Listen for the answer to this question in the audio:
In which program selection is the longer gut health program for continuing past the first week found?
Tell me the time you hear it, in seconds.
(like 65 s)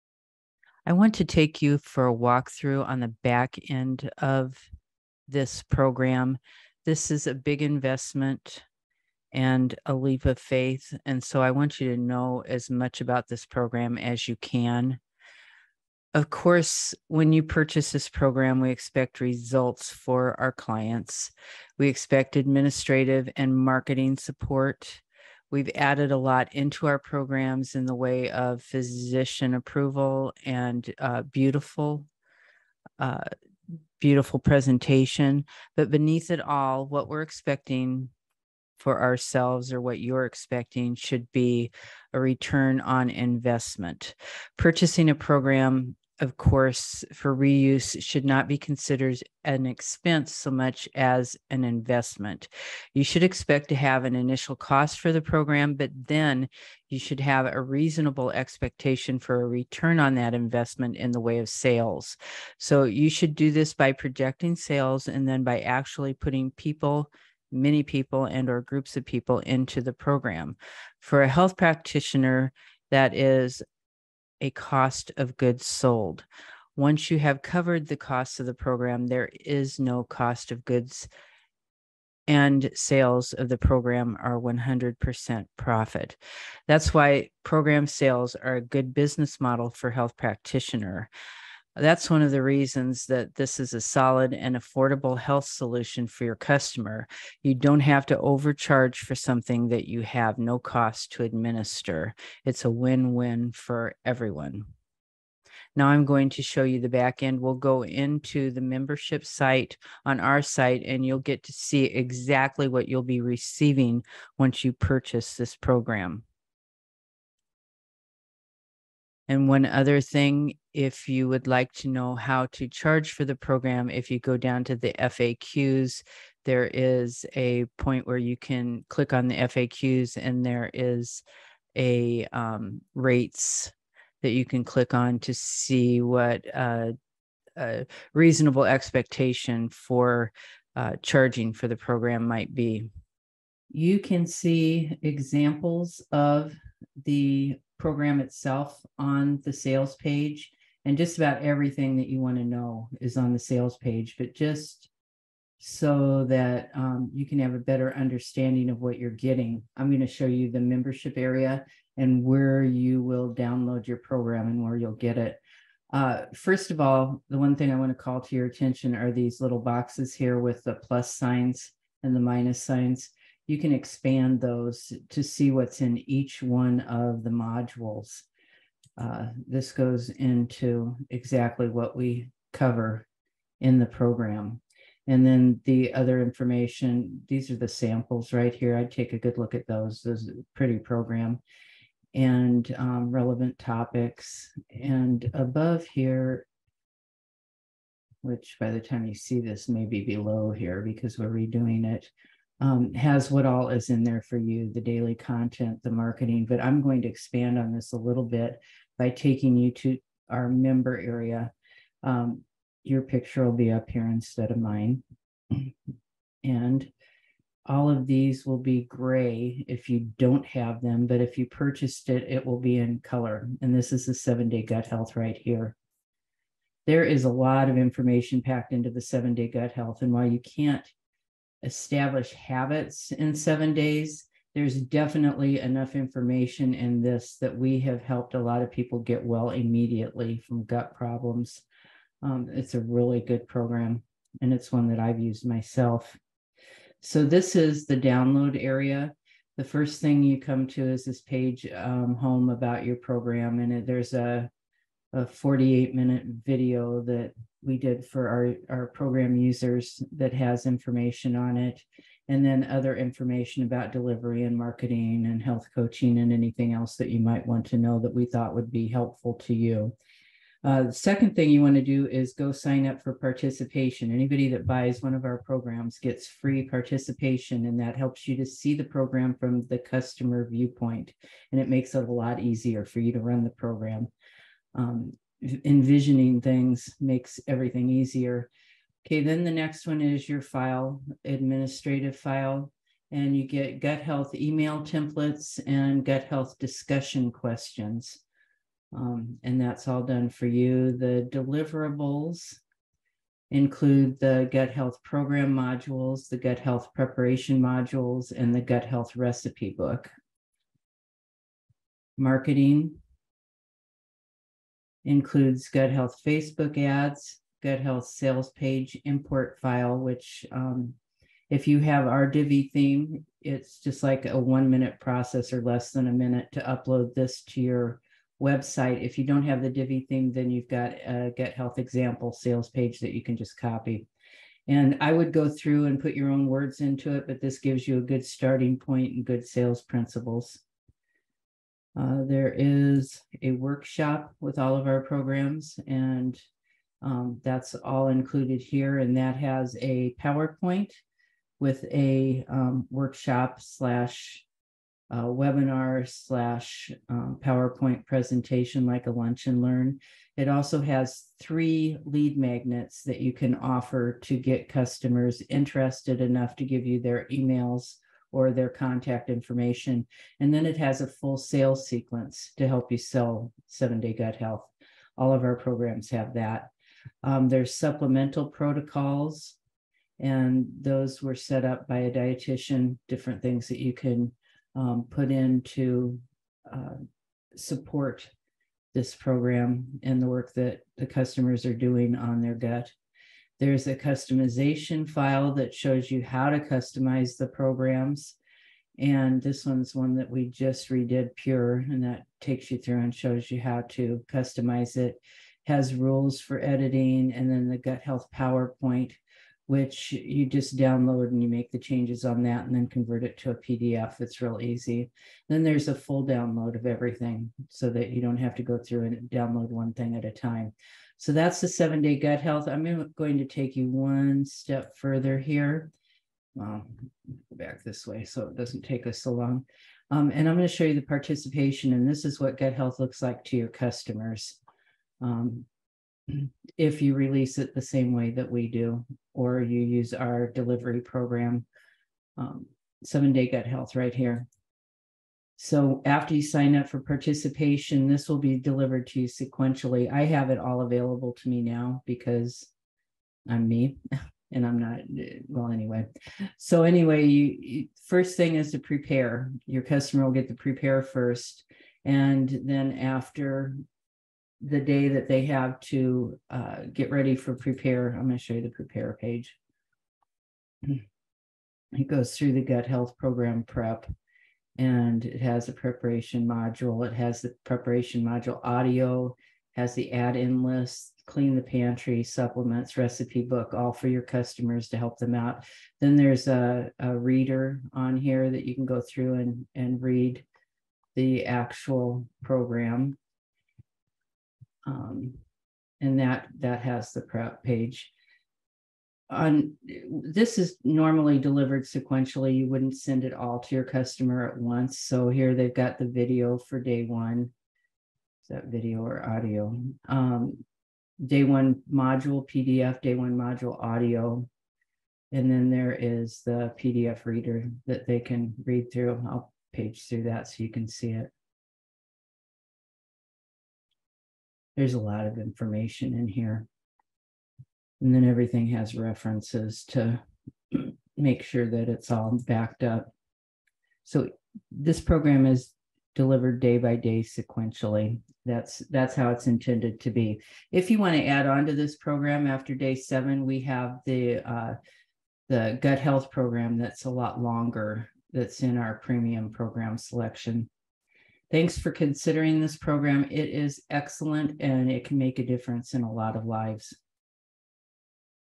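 548 s.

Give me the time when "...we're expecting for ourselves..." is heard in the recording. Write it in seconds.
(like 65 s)
37 s.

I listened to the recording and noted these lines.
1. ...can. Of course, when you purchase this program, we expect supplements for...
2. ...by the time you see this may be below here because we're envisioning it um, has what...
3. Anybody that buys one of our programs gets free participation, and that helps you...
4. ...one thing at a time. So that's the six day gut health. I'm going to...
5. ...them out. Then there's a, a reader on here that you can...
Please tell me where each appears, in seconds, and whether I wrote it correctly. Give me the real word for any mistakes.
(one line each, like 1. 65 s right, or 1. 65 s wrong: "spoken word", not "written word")
1. 14 s wrong: "results", not "supplements"
2. 198 s wrong: "redoing", not "envisioning"
3. 274 s right
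4. 419 s wrong: "seven", not "six"
5. 485 s right.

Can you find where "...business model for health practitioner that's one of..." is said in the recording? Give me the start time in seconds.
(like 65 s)
88 s.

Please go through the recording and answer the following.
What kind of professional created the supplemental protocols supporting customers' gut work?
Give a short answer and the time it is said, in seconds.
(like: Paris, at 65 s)
A dietitian, at 382 s.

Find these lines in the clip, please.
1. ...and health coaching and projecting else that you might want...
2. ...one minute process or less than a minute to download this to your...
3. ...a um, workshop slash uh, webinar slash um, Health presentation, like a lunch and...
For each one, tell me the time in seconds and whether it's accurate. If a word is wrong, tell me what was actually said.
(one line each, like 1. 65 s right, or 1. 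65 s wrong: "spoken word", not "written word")
1. 265 s wrong: "anything", not "projecting"
2. 324 s wrong: "upload", not "download"
3. 351 s wrong: "PowerPoint", not "Health".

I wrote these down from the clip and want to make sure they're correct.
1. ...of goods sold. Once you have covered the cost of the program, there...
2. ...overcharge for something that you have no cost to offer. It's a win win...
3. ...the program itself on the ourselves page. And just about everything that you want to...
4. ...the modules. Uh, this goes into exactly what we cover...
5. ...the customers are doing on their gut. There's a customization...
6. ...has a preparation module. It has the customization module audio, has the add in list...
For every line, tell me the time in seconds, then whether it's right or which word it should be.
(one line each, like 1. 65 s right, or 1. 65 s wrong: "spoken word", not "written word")
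1. 75 s right
2. 98 s wrong: "administer", not "offer"
3. 147 s wrong: "sales", not "ourselves"
4. 177 s right
5. 390 s right
6. 475 s wrong: "preparation", not "customization".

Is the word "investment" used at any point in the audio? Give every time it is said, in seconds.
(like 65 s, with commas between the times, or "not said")
7 s, 43 s, 51 s, 60 s.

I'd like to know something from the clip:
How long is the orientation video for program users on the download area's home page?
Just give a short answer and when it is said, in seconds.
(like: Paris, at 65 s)
48 minutes, at 255 s.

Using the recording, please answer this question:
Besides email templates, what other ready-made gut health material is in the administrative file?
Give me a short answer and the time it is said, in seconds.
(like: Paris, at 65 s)
Discussion questions, at 296 s.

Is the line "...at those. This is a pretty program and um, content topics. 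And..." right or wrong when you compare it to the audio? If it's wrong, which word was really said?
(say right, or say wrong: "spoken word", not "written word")
wrong: "relevant", not "content".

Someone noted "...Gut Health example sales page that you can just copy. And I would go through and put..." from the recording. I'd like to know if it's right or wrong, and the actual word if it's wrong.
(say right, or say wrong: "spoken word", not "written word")
right.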